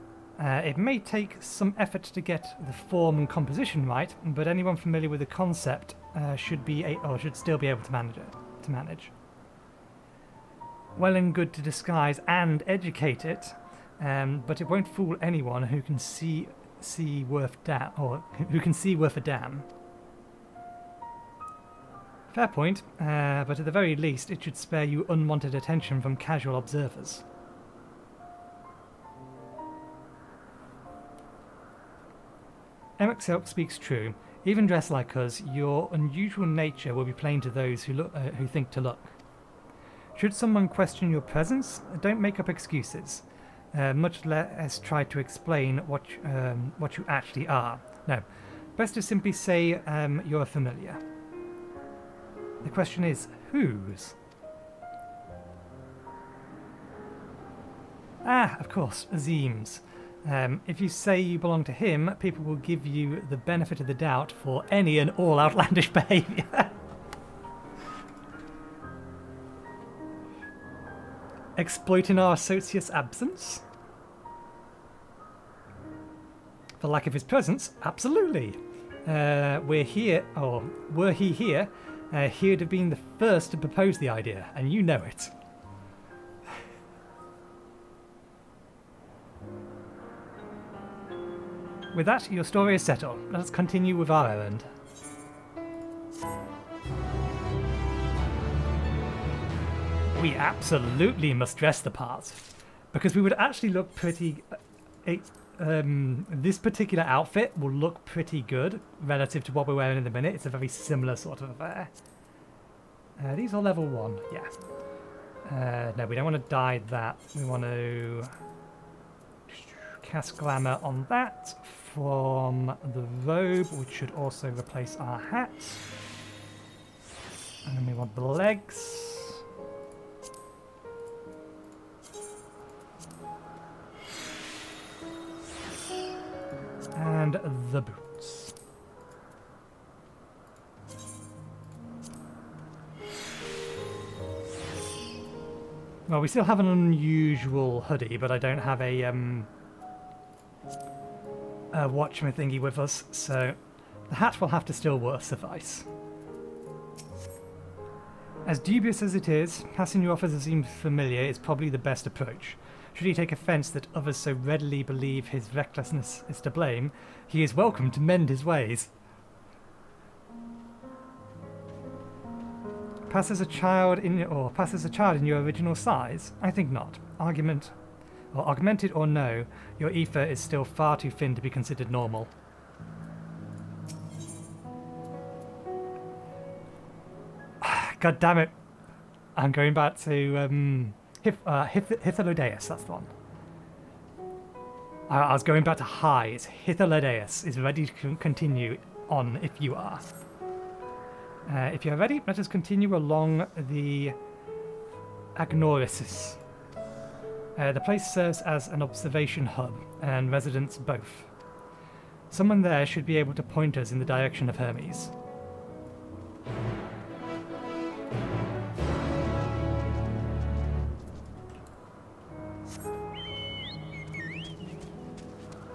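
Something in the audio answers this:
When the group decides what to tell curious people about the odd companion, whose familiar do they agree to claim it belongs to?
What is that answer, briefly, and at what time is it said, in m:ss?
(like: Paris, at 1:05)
Azem, at 0:59.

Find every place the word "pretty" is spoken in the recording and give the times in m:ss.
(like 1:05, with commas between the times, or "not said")
1:43, 1:48.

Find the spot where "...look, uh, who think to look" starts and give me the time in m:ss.
0:37.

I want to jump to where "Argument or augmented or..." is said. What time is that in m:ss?
2:57.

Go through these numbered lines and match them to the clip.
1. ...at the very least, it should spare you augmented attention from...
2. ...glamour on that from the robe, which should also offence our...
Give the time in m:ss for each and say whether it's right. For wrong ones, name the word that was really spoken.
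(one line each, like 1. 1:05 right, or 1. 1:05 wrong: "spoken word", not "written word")
1. 0:23 wrong: "unwanted", not "augmented"
2. 2:00 wrong: "replace", not "offence".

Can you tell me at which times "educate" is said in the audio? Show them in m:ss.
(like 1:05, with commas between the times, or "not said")
0:12.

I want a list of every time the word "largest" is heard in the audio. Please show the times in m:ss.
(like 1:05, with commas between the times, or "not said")
not said.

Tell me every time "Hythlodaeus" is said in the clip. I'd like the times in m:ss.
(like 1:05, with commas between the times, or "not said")
3:11, 3:16.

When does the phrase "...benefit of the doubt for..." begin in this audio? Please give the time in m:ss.
1:03.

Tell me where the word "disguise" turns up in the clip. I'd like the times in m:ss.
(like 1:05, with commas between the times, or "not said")
0:11.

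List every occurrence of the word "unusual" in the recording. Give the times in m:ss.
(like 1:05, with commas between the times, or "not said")
0:35, 2:26.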